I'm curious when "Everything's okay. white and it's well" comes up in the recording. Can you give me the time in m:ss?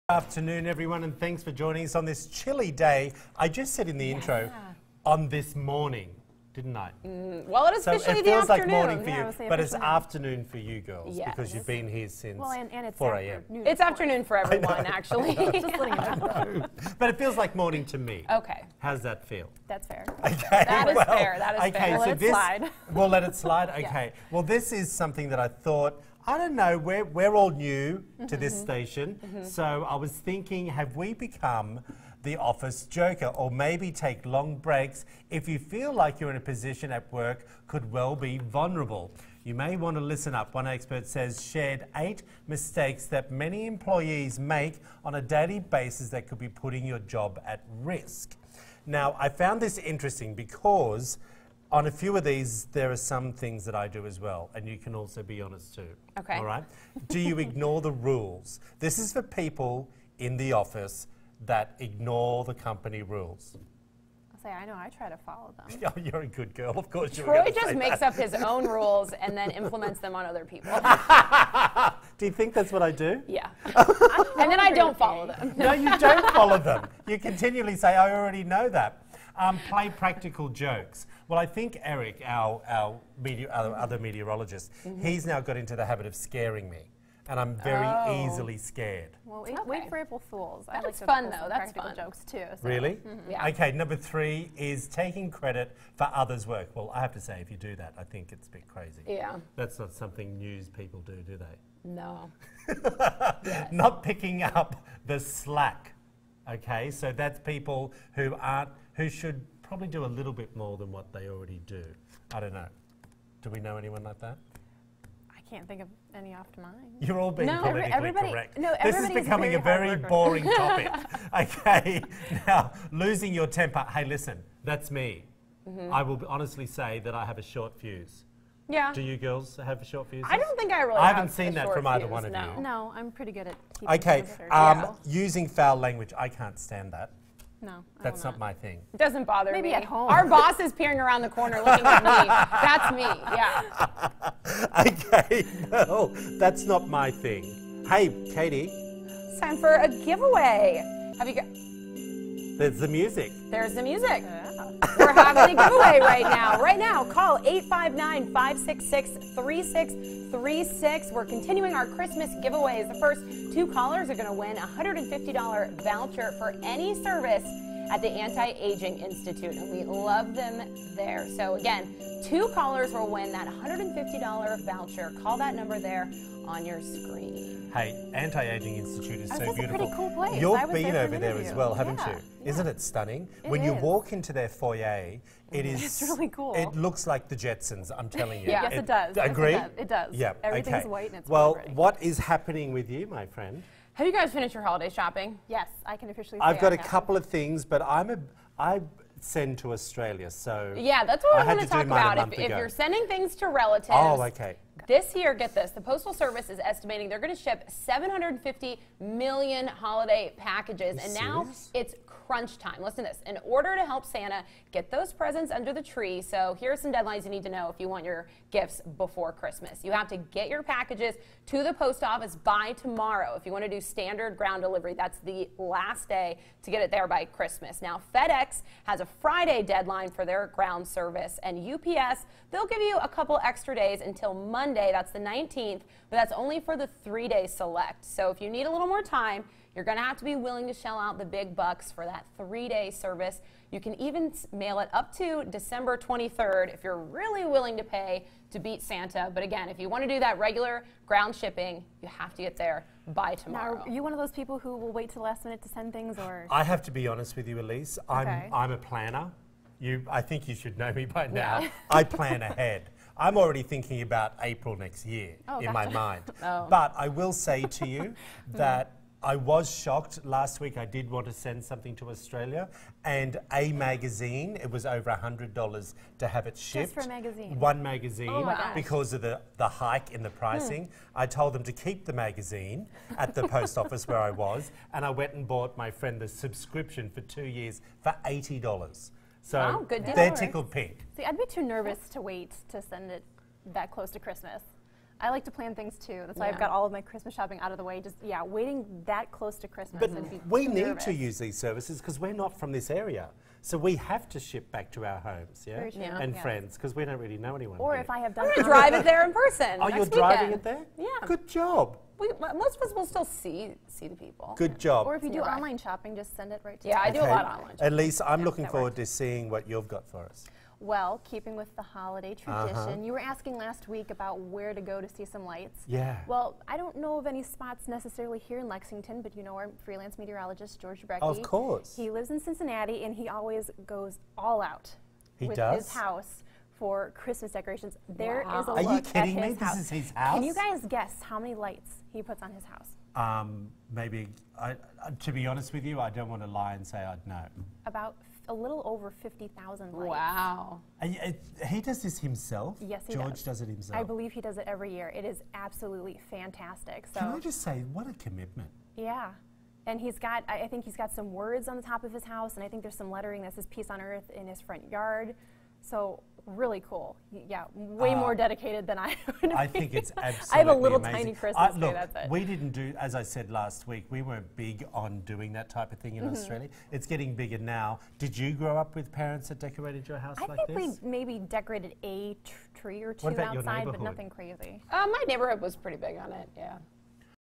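3:10.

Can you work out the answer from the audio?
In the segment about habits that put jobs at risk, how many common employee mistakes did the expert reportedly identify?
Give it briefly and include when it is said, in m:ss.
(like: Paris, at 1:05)
8, at 0:41.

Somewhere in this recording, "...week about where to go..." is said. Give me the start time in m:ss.
5:23.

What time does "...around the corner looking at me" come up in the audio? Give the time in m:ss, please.
2:20.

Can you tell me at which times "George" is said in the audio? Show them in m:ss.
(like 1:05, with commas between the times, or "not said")
5:30, 5:53.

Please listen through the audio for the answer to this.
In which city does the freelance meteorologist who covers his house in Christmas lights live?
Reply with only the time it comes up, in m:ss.
5:32.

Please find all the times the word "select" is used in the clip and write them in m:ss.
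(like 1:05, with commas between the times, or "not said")
3:57.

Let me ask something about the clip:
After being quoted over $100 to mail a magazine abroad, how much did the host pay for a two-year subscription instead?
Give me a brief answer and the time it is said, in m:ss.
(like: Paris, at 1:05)
$80, at 4:48.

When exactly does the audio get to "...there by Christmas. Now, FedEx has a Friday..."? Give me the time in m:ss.
3:46.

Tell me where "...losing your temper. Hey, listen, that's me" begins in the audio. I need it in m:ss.
2:02.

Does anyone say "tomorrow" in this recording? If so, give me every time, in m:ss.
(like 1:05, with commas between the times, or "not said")
3:42, 4:13.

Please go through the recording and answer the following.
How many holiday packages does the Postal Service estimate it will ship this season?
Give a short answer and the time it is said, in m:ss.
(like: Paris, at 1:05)
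750 million, at 3:27.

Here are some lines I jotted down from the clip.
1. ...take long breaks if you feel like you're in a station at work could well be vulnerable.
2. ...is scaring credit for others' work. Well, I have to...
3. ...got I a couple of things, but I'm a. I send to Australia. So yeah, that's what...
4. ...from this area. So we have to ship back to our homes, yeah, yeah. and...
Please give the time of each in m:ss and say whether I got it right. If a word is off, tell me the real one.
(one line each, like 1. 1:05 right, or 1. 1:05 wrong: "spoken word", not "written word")
1. 0:33 wrong: "position", not "station"
2. 1:34 wrong: "taking", not "scaring"
3. 3:16 right
4. 5:02 right.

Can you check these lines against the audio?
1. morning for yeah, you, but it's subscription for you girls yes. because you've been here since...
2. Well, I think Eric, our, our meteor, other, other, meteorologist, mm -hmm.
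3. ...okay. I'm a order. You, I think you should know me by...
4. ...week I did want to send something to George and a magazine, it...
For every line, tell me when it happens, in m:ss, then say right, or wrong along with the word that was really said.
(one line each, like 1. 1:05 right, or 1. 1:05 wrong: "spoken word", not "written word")
1. 0:08 wrong: "afternoon", not "subscription"
2. 1:21 right
3. 4:18 wrong: "planner", not "order"
4. 4:30 wrong: "Australia", not "George".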